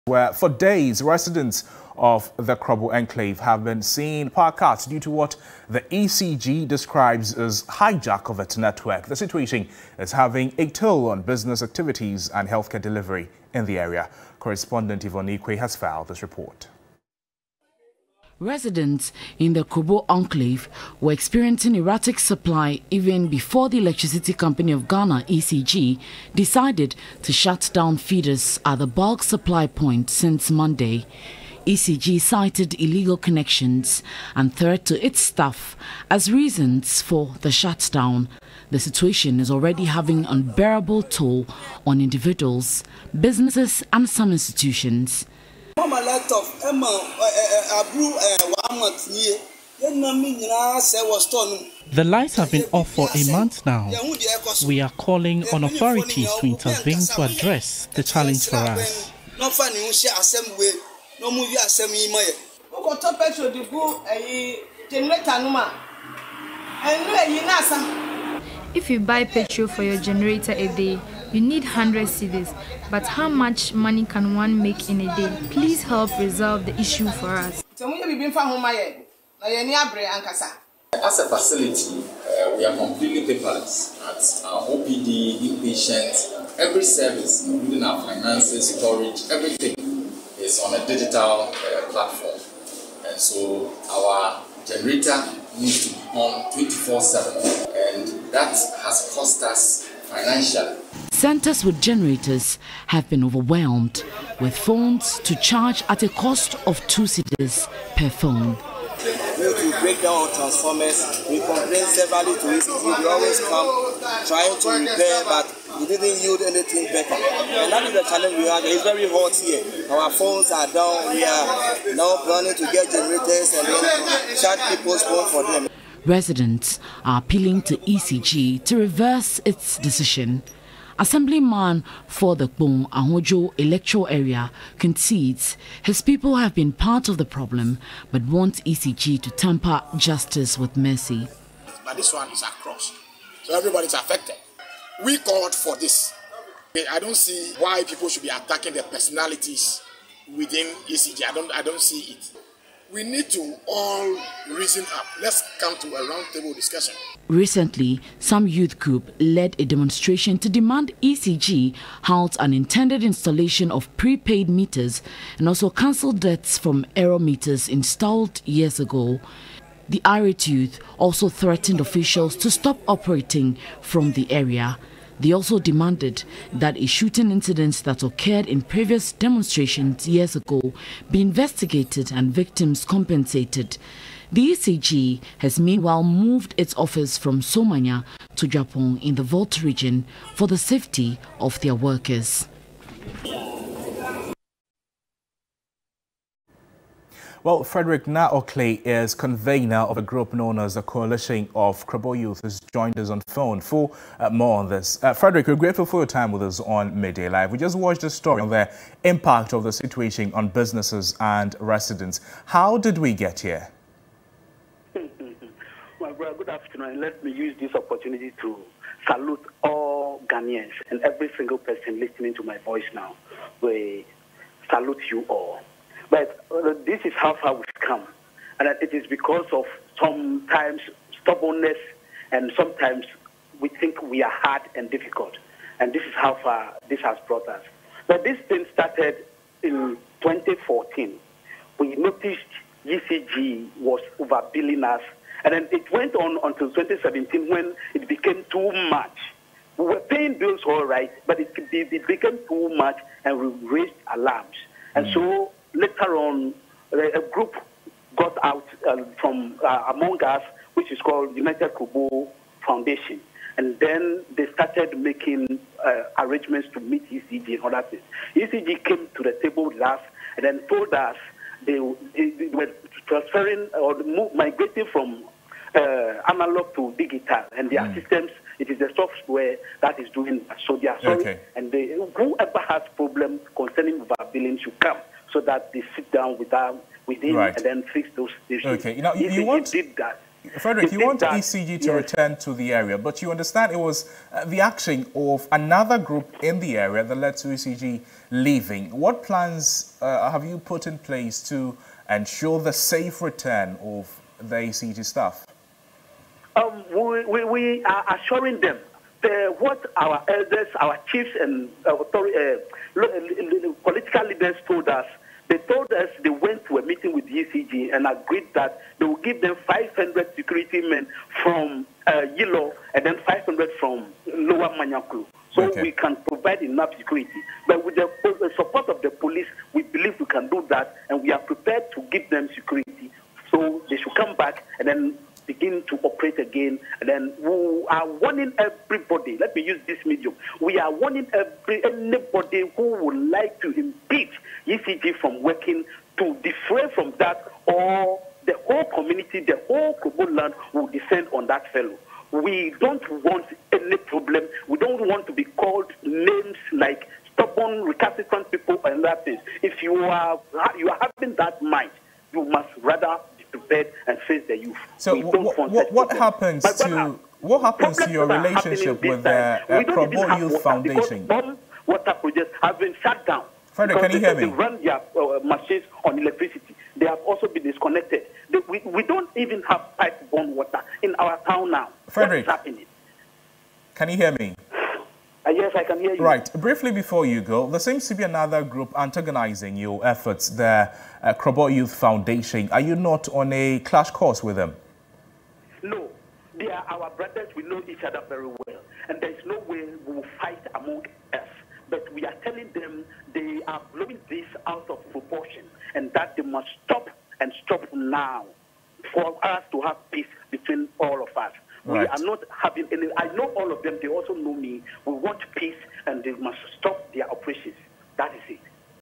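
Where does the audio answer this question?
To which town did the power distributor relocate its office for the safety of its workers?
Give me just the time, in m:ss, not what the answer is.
3:08.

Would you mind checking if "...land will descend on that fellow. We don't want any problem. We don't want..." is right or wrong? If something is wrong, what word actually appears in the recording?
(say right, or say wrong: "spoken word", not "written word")
right.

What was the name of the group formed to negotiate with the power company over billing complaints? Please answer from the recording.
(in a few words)
United Krobo Foundation.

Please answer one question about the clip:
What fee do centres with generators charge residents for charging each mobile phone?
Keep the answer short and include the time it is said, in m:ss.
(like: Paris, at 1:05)
2 cedis, at 1:46.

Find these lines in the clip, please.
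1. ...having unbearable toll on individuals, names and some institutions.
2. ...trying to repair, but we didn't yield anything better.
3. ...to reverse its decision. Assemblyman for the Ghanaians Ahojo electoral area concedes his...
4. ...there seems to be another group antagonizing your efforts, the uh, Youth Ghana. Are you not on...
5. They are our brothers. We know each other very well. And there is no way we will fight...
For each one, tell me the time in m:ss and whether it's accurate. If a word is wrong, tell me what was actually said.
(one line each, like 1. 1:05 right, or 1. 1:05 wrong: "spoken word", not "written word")
1. 0:39 wrong: "businesses", not "names"
2. 1:54 right
3. 2:08 wrong: "Kpong", not "Ghanaians"
4. 6:27 wrong: "Foundation", not "Ghana"
5. 6:36 right.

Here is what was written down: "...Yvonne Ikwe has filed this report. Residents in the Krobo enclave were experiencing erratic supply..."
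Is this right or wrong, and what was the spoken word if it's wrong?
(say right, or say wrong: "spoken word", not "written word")
right.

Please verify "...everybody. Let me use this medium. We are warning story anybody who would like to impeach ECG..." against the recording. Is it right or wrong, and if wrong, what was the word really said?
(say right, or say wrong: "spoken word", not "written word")
wrong: "every", not "story".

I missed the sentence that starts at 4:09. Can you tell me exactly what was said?
We were paying bills all right, but it, it became too much and we raised alarms.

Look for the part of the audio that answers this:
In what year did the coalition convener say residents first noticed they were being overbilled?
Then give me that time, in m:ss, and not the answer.
4:00.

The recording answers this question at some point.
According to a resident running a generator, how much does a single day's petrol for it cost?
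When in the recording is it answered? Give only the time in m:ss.
1:11.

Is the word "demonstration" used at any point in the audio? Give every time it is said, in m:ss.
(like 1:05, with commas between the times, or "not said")
2:39, 2:59.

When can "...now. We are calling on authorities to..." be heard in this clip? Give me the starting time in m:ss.
0:53.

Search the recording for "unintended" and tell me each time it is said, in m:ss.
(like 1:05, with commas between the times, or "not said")
2:42.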